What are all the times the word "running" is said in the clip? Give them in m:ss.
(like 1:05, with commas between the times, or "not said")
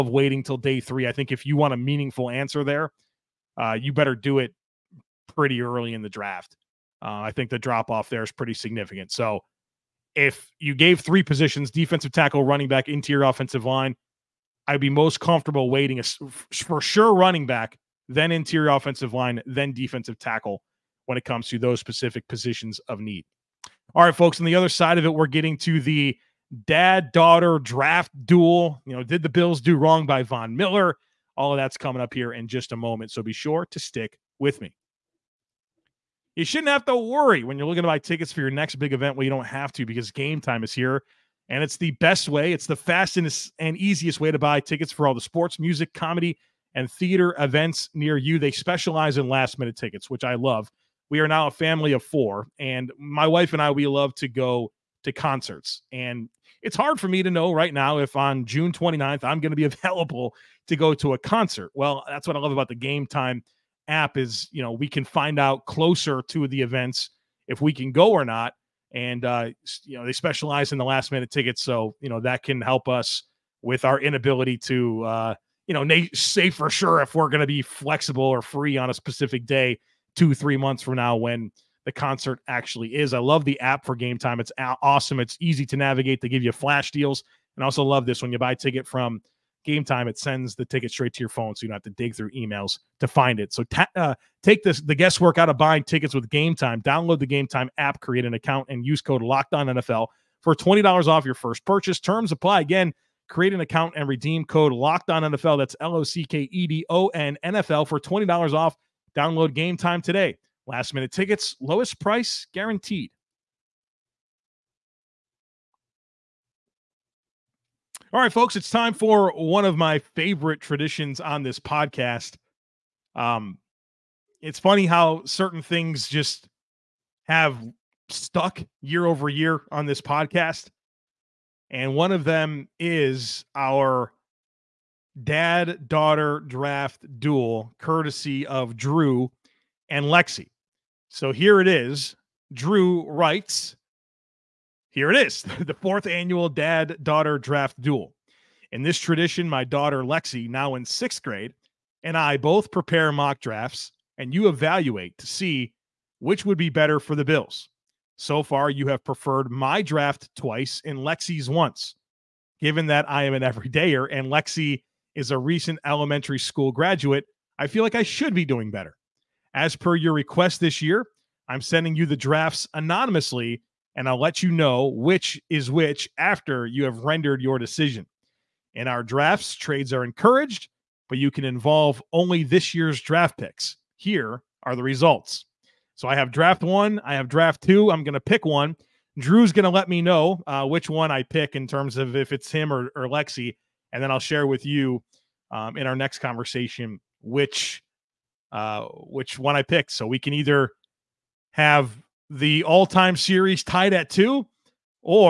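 0:12, 0:17.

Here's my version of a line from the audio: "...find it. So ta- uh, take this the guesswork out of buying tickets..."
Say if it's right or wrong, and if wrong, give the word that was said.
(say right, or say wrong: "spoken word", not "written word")
right.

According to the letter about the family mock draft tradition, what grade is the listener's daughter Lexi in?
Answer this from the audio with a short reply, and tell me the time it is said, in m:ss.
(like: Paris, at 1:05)
Sixth grade, at 2:30.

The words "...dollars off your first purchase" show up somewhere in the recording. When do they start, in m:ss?
1:40.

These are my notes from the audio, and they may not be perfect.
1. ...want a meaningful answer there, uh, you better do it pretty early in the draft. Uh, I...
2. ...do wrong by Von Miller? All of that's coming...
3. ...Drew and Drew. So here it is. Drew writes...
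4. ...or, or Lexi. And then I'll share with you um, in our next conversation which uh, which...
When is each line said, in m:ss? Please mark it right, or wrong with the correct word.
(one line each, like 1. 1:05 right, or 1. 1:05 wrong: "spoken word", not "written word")
1. 0:01 right
2. 0:29 right
3. 2:18 wrong: "Lexi", not "Drew"
4. 3:12 right.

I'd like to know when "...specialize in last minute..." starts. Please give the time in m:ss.
0:48.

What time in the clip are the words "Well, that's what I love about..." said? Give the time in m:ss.
1:01.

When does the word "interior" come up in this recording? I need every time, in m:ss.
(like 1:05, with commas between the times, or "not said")
0:12, 0:18.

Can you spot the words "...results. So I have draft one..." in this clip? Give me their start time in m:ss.
3:04.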